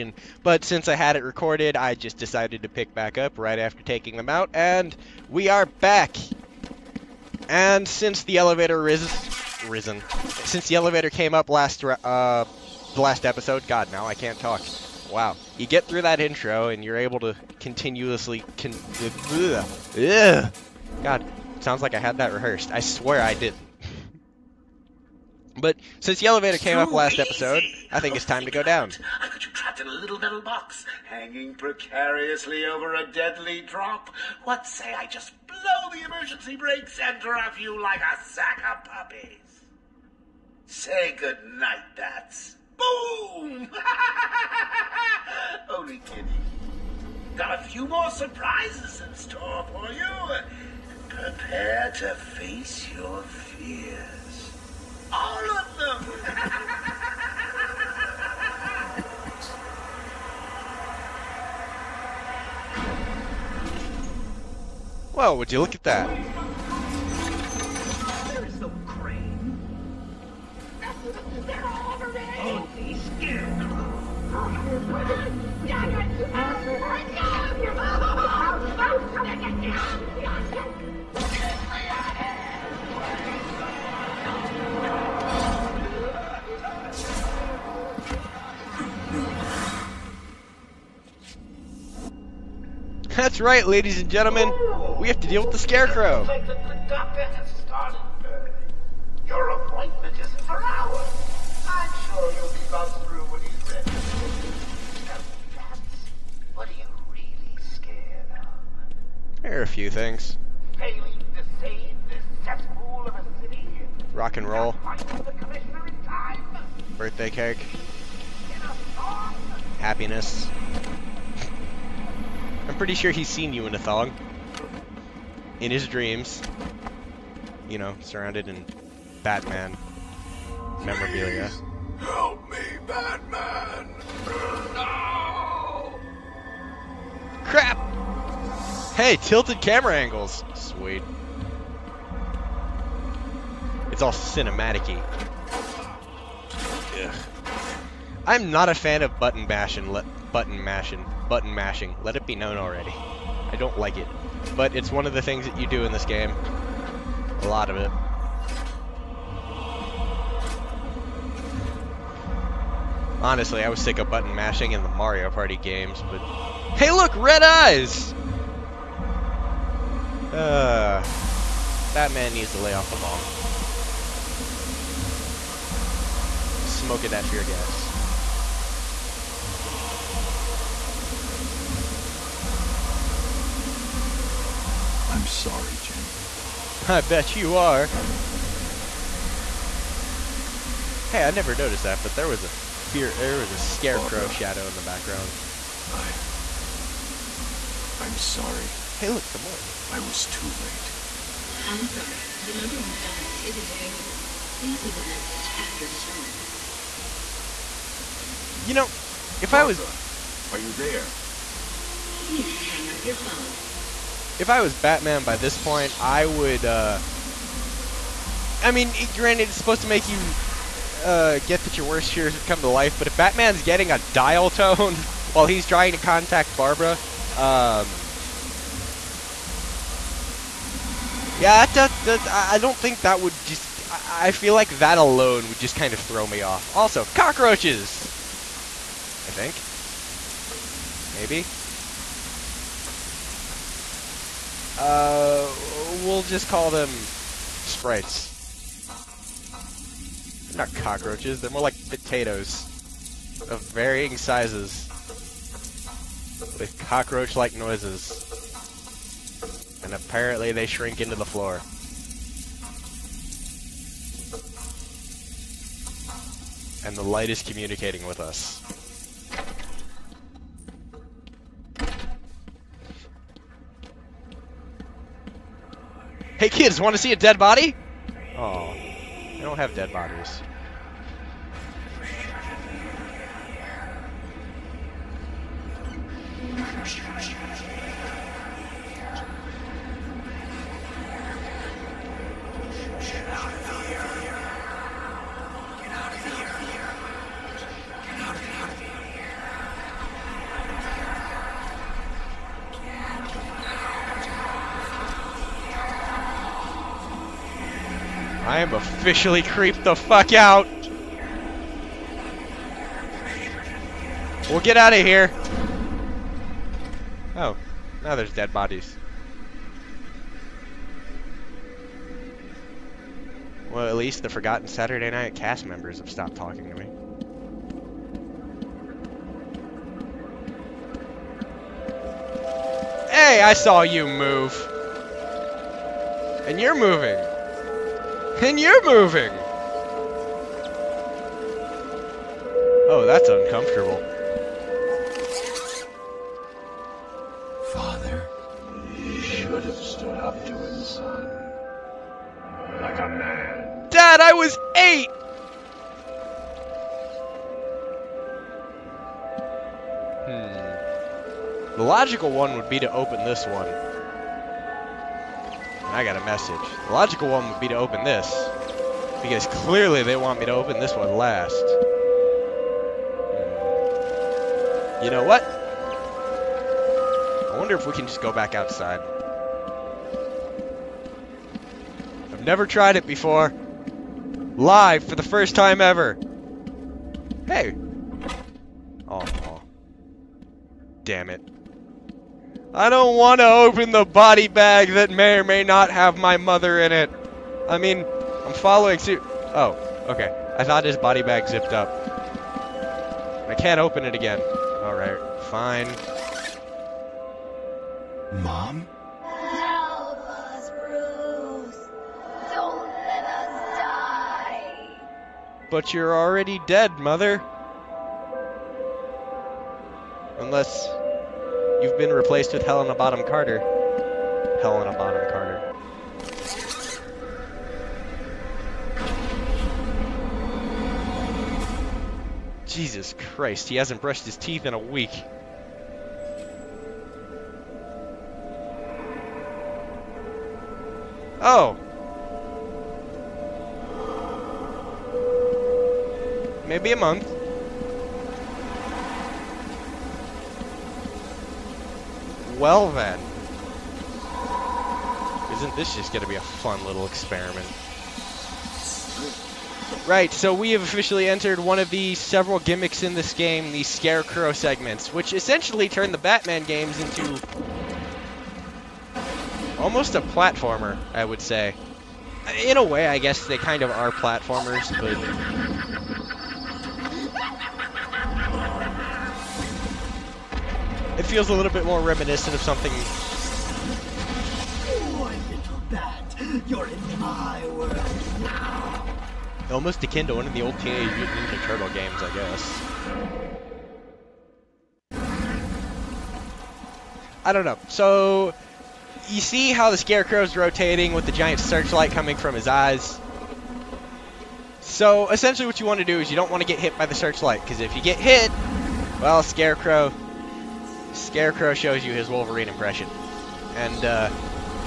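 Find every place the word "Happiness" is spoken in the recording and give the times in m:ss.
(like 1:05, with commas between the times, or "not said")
1:59.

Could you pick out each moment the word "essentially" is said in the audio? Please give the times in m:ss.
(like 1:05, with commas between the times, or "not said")
7:45, 8:25.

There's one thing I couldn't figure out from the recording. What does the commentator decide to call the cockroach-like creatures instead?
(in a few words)
sprites.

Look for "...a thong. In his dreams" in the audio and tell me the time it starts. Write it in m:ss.
2:03.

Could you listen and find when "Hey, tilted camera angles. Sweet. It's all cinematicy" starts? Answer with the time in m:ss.
2:18.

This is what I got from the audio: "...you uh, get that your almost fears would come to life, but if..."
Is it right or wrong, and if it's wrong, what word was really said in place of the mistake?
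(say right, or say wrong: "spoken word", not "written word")
wrong: "worst", not "almost".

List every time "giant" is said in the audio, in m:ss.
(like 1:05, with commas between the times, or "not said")
8:21.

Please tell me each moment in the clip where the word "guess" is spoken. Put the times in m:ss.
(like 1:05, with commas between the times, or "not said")
7:53, 8:12.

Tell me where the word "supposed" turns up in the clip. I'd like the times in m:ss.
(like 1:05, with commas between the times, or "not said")
3:39.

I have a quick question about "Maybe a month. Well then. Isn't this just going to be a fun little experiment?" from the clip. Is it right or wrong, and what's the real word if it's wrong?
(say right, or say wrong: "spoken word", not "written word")
right.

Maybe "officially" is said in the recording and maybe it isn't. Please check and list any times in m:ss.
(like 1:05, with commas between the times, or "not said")
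5:08, 7:40.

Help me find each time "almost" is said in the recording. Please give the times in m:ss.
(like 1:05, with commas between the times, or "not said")
7:49, 8:09.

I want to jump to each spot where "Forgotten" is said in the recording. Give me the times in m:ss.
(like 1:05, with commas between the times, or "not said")
5:24.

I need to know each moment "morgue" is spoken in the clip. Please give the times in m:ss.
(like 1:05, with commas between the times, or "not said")
3:19.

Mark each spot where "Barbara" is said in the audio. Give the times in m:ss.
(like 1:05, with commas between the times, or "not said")
3:14, 3:29, 3:46.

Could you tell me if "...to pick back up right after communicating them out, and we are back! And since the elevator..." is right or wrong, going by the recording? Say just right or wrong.
wrong.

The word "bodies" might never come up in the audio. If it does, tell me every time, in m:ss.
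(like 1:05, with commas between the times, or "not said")
4:39, 5:18.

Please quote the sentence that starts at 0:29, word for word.
I got you trapped in a little metal box, hanging precariously over a deadly drop.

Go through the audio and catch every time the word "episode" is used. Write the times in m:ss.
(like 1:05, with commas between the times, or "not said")
0:13, 0:27.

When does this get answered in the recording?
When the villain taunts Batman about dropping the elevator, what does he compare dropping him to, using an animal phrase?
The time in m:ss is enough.
0:38.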